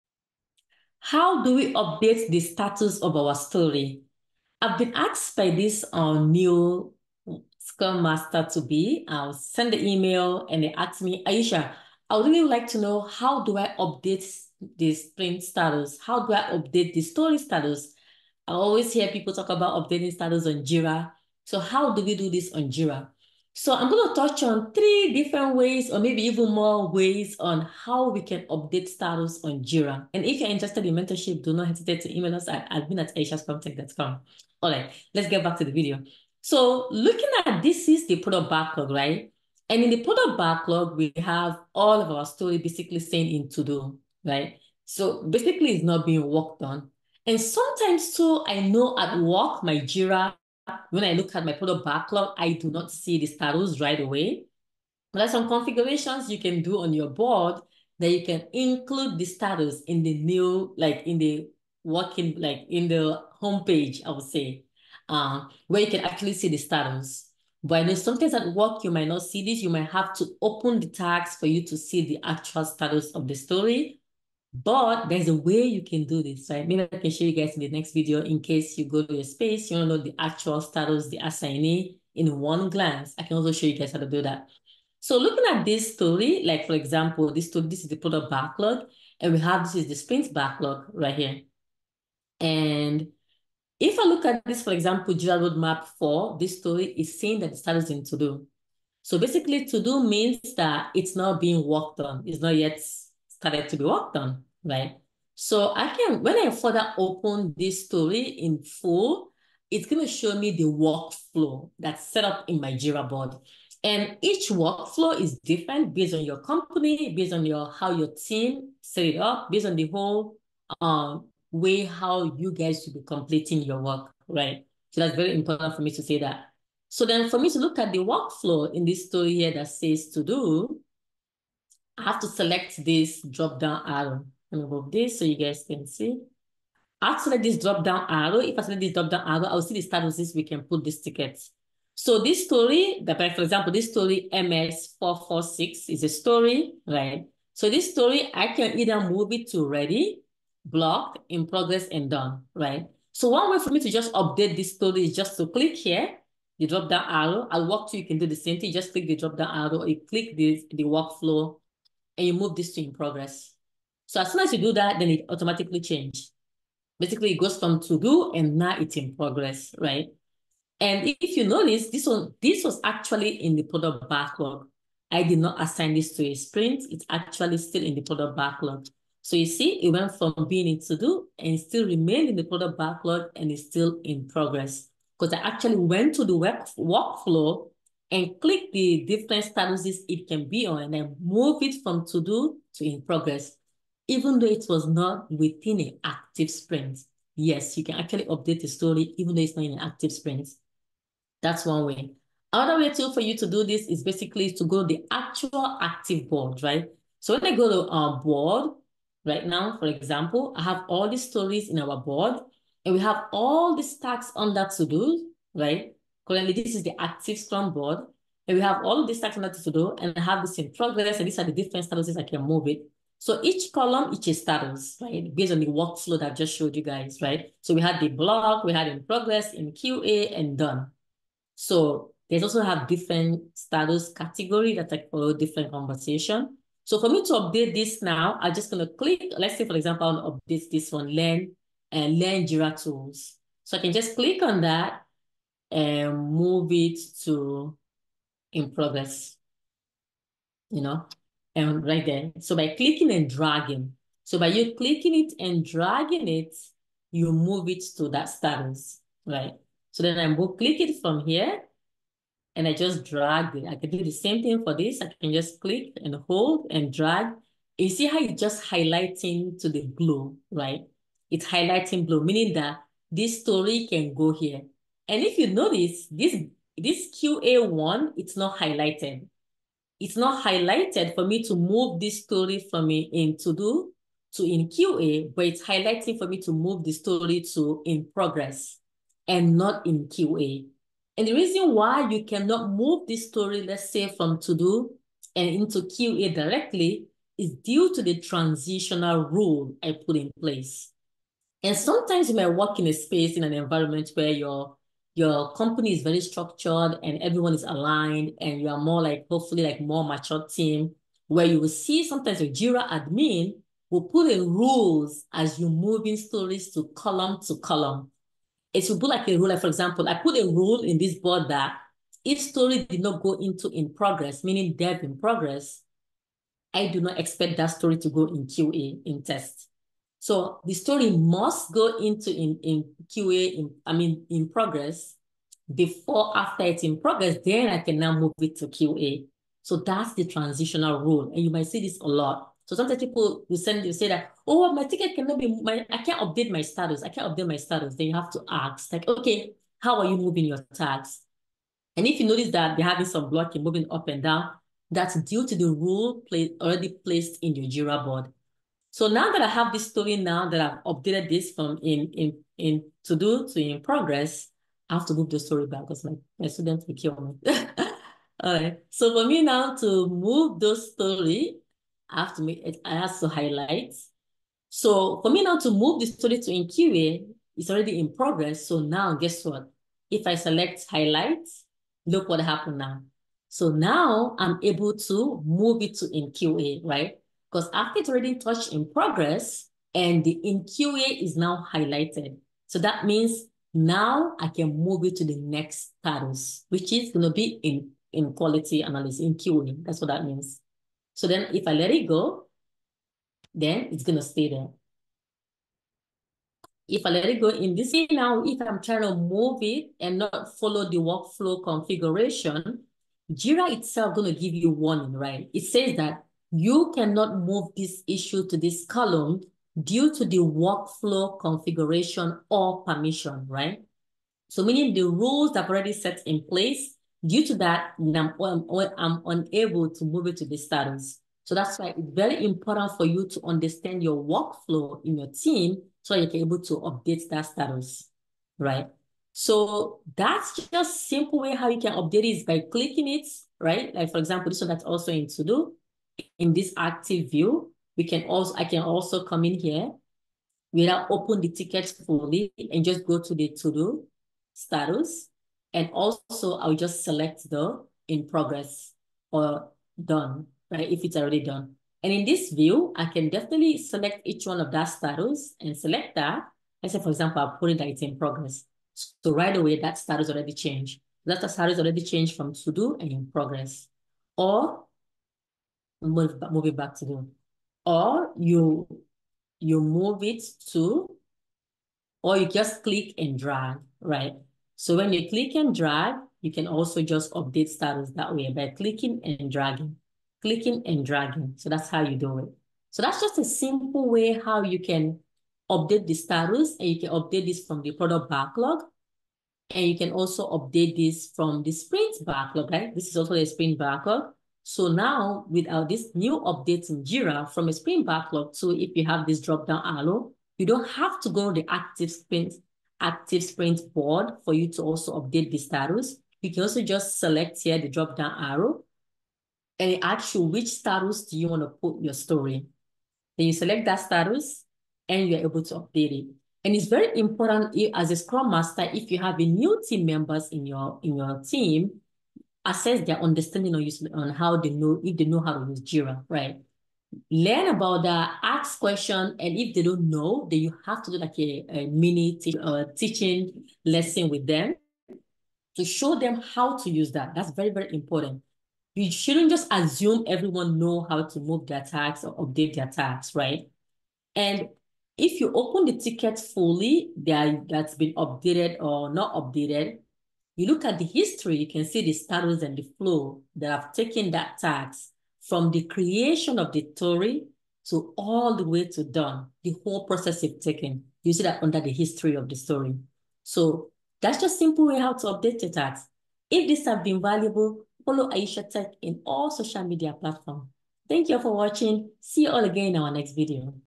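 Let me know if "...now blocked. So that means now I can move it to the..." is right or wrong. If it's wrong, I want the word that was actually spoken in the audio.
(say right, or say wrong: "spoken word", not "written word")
wrong: "highlighted", not "blocked".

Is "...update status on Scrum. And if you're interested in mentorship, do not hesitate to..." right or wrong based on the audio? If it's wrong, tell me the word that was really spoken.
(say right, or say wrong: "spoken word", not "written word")
wrong: "Jira", not "Scrum".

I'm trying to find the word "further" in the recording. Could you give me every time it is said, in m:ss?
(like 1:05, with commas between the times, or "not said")
1:46.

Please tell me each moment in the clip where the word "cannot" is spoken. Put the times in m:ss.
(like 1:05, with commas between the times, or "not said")
4:52, 5:45, 6:56.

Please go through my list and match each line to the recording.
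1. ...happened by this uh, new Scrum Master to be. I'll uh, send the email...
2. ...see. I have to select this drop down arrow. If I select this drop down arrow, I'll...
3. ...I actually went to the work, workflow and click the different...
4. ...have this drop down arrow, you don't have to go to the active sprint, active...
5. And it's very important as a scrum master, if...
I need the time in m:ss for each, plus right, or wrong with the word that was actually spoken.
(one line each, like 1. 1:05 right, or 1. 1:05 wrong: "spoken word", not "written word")
1. 0:04 wrong: "asked", not "happened"
2. 2:15 right
3. 3:05 right
4. 8:29 right
5. 8:46 right.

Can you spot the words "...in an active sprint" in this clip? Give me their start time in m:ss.
3:19.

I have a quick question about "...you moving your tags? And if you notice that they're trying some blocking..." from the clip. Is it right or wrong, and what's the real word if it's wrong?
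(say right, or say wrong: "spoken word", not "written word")
wrong: "having", not "trying".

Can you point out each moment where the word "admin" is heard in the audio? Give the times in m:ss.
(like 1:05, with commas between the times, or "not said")
0:32, 5:12.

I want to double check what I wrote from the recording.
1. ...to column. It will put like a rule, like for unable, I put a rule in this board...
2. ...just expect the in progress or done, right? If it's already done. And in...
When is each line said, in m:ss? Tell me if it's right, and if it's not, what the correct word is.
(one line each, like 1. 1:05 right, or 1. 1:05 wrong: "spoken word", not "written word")
1. 5:17 wrong: "example", not "unable"
2. 7:36 wrong: "select", not "expect".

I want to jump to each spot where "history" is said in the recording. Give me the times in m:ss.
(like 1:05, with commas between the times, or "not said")
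9:21, 9:31.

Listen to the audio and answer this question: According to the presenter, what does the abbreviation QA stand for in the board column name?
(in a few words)
quality analysis.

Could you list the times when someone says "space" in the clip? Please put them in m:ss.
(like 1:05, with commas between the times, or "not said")
1:19, 5:02.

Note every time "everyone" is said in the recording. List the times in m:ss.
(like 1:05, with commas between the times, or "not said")
5:07, 9:10.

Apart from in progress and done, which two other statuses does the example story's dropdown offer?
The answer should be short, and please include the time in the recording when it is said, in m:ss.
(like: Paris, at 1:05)
ready, blocked, at 2:29.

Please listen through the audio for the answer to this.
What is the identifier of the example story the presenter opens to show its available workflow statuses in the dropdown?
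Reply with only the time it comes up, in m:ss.
2:24.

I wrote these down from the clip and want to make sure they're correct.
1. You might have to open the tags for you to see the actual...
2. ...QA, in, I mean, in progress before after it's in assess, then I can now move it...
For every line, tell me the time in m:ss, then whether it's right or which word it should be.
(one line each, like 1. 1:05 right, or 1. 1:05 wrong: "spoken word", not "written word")
1. 1:09 right
2. 5:33 wrong: "progress", not "assess".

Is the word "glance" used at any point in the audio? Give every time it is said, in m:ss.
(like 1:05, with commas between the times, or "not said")
1:22.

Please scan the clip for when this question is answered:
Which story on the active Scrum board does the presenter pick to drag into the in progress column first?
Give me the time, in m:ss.
4:02.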